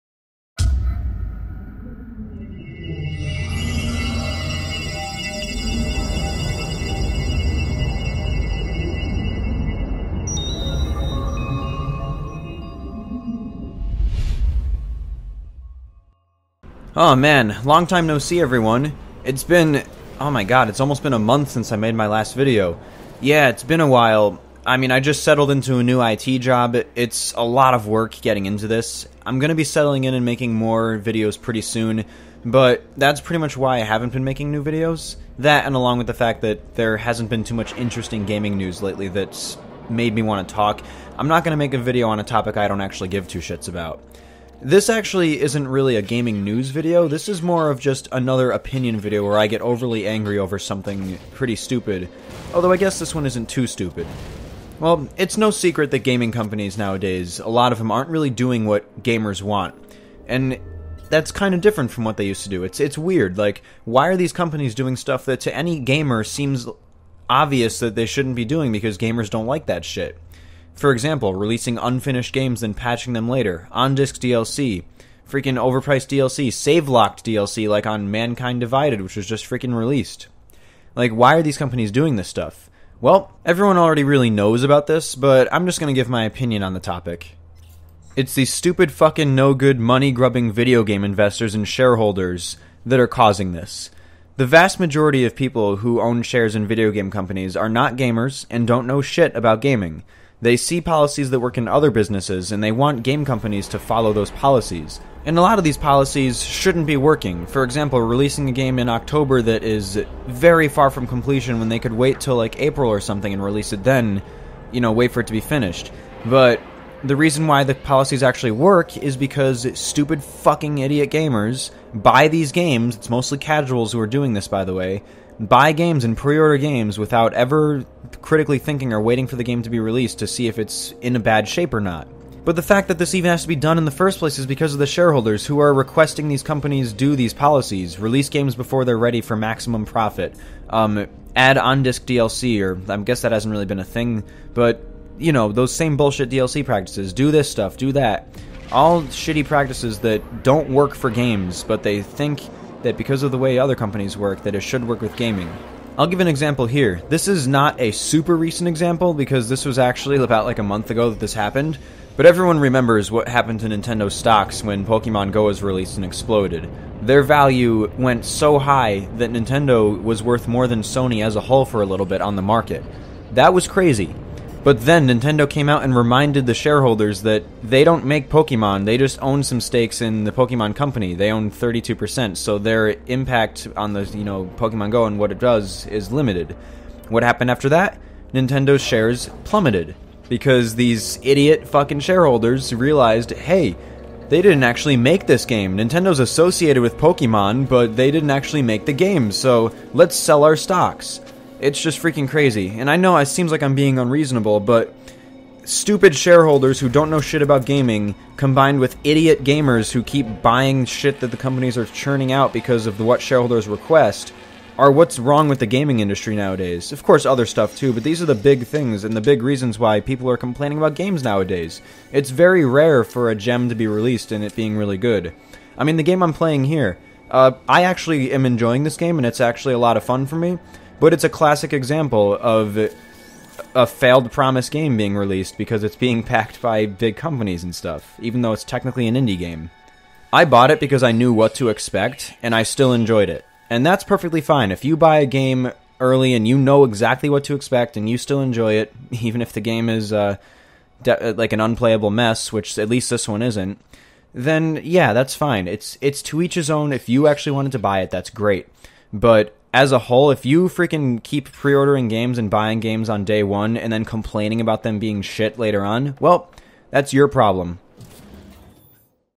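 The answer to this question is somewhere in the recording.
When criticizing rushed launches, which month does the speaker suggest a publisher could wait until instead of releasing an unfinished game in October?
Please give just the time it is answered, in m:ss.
1:52.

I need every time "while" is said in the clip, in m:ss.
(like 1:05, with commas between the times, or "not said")
0:23.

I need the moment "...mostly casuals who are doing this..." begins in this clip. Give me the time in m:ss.
2:03.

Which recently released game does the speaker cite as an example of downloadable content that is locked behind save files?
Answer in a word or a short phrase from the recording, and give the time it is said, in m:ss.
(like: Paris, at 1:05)
Mankind Divided, at 1:18.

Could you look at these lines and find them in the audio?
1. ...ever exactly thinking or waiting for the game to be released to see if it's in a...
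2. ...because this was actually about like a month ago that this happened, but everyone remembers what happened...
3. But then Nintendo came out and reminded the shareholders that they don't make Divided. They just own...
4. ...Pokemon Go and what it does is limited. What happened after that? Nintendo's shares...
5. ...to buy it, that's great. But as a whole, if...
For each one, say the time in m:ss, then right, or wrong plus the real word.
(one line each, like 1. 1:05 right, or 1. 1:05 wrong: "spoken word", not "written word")
1. 2:07 wrong: "critically", not "exactly"
2. 2:39 right
3. 2:54 wrong: "Pokemon", not "Divided"
4. 3:04 right
5. 4:17 right.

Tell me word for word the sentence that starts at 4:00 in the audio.
I bought it because I knew what to expect, and I still enjoyed it.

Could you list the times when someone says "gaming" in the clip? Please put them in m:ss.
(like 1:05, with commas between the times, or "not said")
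0:38, 0:46, 0:55, 1:39, 2:35, 3:27, 3:35.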